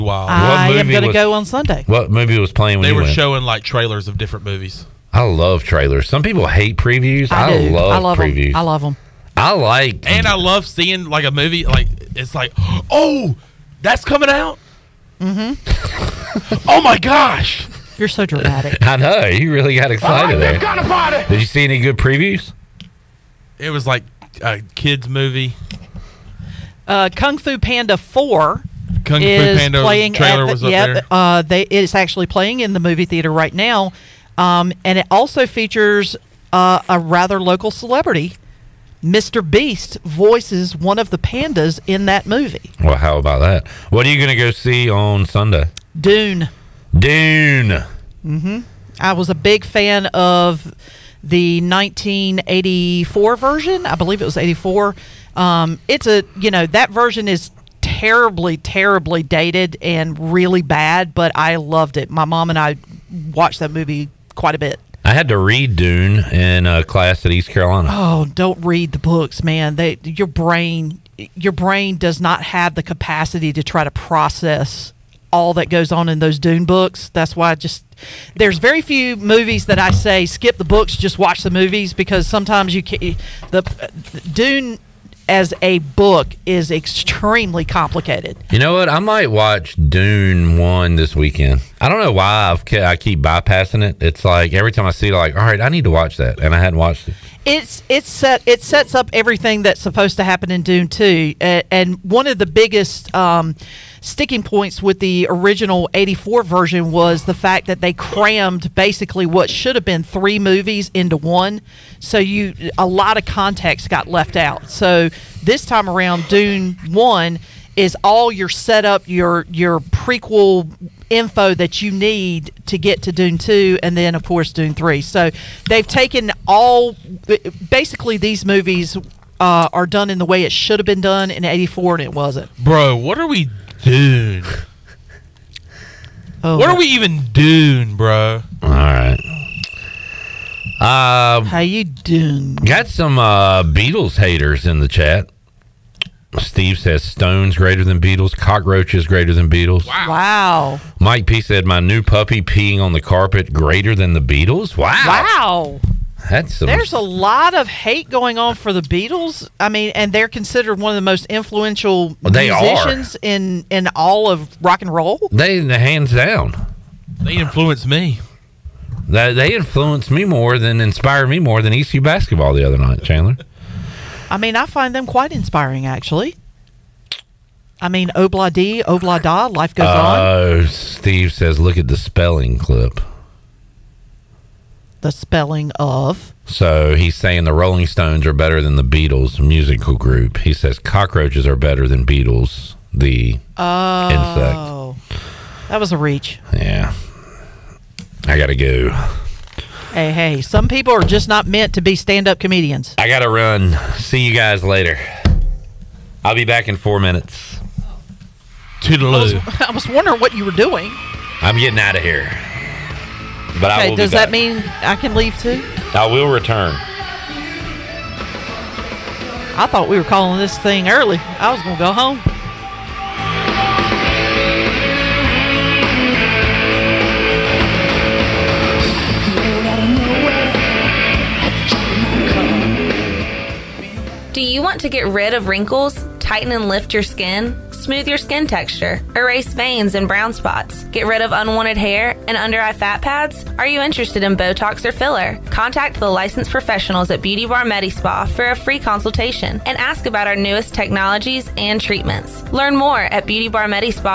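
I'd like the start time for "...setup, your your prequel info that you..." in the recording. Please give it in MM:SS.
01:58.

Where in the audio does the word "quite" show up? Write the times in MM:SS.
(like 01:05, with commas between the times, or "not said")
01:04, 02:55.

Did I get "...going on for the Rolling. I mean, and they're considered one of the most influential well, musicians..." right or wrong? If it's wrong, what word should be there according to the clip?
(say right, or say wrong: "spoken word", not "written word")
wrong: "Beatles", not "Rolling".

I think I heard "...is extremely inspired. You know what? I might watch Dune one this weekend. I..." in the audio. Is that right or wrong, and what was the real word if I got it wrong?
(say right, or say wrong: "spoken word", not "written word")
wrong: "complicated", not "inspired".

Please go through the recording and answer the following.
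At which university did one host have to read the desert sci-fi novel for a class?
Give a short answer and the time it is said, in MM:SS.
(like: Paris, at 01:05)
East Carolina, at 01:07.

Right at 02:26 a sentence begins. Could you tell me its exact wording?
Steve says Stones greater than Beatles, cockroaches greater than Beatles.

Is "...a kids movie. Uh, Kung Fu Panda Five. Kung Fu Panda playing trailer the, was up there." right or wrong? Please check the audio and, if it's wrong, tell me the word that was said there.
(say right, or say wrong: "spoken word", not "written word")
wrong: "Four", not "Five".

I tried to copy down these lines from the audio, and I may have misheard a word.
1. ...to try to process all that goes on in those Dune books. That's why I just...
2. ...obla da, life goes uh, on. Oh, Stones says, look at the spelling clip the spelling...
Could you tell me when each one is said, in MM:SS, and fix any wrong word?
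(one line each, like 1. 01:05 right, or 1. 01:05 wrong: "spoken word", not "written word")
1. 01:13 right
2. 02:58 wrong: "Steve", not "Stones".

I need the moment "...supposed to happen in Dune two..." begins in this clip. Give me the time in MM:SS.
01:39.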